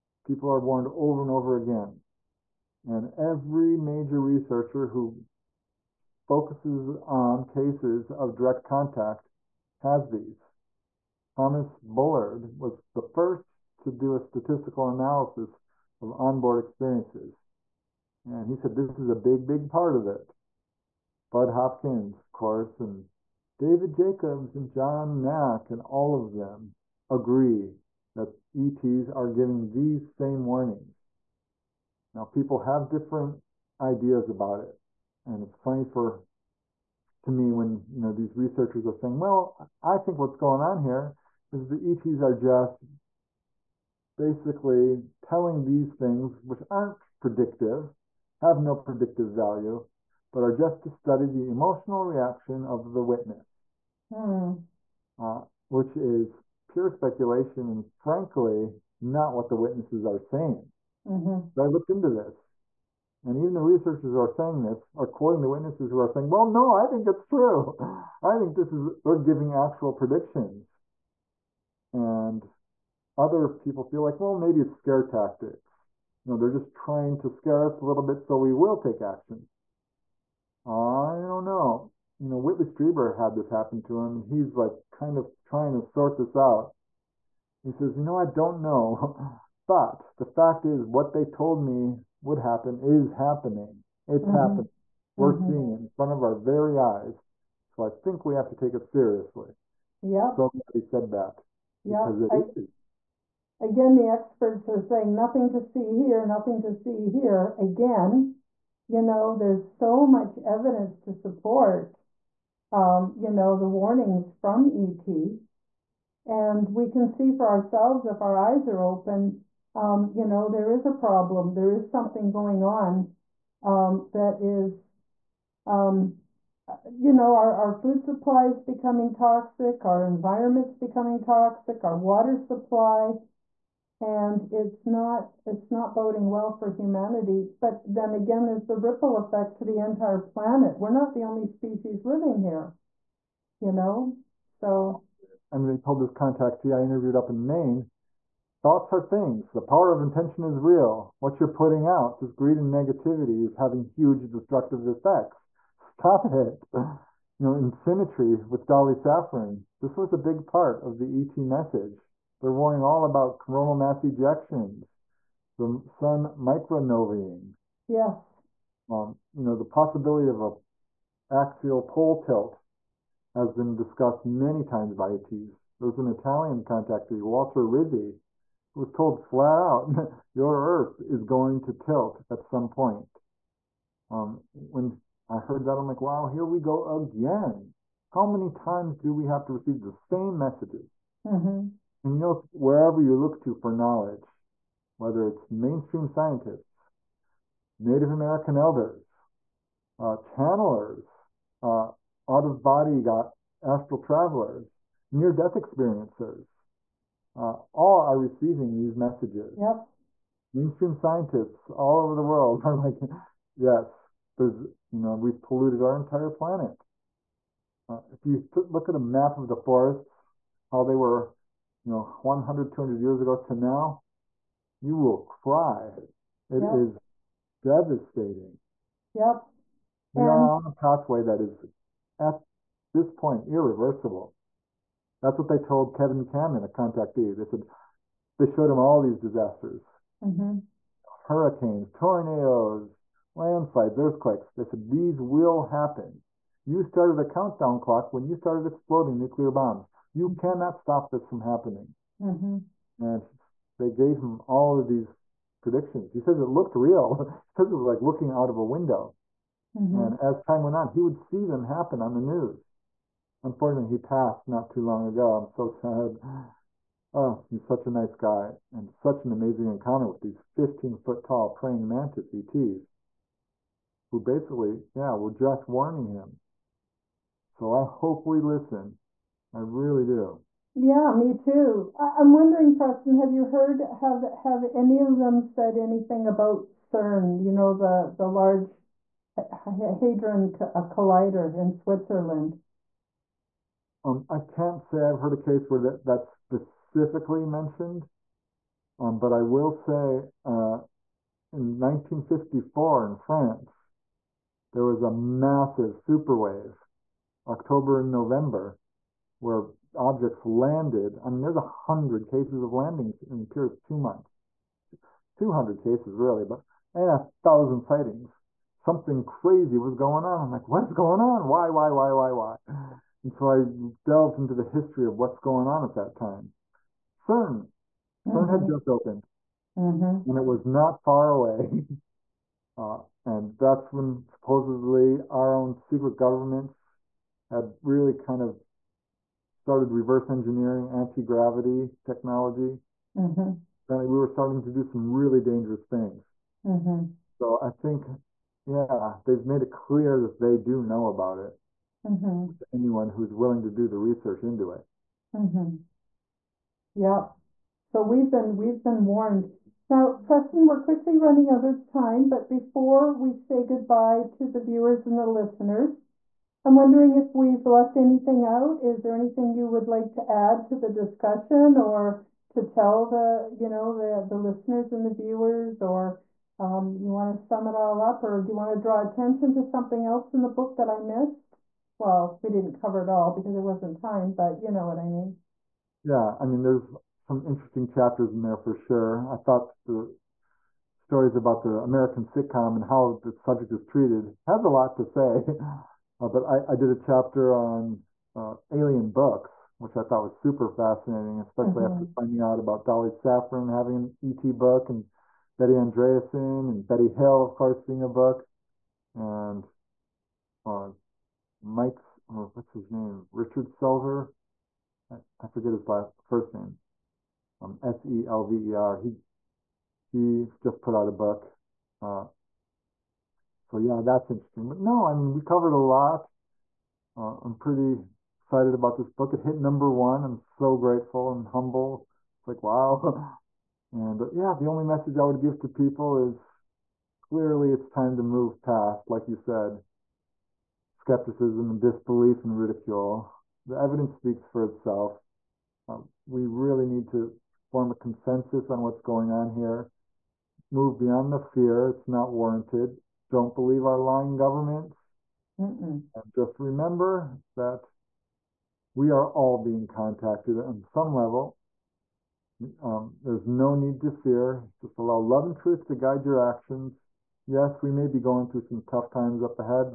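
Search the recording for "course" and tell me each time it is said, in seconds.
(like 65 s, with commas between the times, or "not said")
22 s, 407 s.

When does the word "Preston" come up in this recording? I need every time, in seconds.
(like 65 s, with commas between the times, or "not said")
282 s, 360 s.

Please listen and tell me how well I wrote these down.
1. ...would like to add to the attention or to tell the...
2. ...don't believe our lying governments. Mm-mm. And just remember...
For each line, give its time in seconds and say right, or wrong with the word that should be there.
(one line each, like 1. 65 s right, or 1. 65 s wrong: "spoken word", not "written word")
1. 369 s wrong: "discussion", not "attention"
2. 453 s right.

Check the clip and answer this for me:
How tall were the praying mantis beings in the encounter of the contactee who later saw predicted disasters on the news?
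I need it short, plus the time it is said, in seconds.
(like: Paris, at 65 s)
15 feet, at 270 s.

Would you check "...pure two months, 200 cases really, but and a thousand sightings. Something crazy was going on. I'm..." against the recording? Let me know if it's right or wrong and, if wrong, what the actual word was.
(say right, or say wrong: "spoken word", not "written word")
right.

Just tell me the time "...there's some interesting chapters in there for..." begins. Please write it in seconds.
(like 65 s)
386 s.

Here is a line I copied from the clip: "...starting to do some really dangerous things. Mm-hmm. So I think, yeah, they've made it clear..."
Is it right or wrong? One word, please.
right.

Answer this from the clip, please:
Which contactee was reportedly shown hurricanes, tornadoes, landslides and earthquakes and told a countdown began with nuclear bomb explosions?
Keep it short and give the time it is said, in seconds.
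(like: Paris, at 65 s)
Kevin Cameron, at 235 s.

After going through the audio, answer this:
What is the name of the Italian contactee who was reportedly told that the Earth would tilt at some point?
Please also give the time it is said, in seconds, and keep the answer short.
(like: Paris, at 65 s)
Walter Rizzi, at 177 s.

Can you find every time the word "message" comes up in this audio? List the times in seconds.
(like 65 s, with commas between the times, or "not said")
161 s, 190 s, 208 s, 434 s.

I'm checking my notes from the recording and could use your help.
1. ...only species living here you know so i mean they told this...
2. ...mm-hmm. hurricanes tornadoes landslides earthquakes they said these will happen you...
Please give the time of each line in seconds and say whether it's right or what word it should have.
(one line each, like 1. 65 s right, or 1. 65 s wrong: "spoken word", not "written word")
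1. 141 s right
2. 240 s right.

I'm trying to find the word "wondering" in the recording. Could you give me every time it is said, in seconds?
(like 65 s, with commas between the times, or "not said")
282 s, 366 s.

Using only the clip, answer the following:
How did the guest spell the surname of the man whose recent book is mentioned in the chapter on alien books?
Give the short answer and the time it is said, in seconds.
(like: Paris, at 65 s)
S E L V E R, at 417 s.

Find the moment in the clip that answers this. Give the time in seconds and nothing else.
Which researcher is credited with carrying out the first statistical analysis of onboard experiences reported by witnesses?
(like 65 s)
11 s.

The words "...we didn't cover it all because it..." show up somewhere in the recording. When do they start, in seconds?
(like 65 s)
382 s.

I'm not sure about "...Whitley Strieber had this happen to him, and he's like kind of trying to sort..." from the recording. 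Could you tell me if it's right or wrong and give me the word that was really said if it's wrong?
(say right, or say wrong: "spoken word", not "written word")
right.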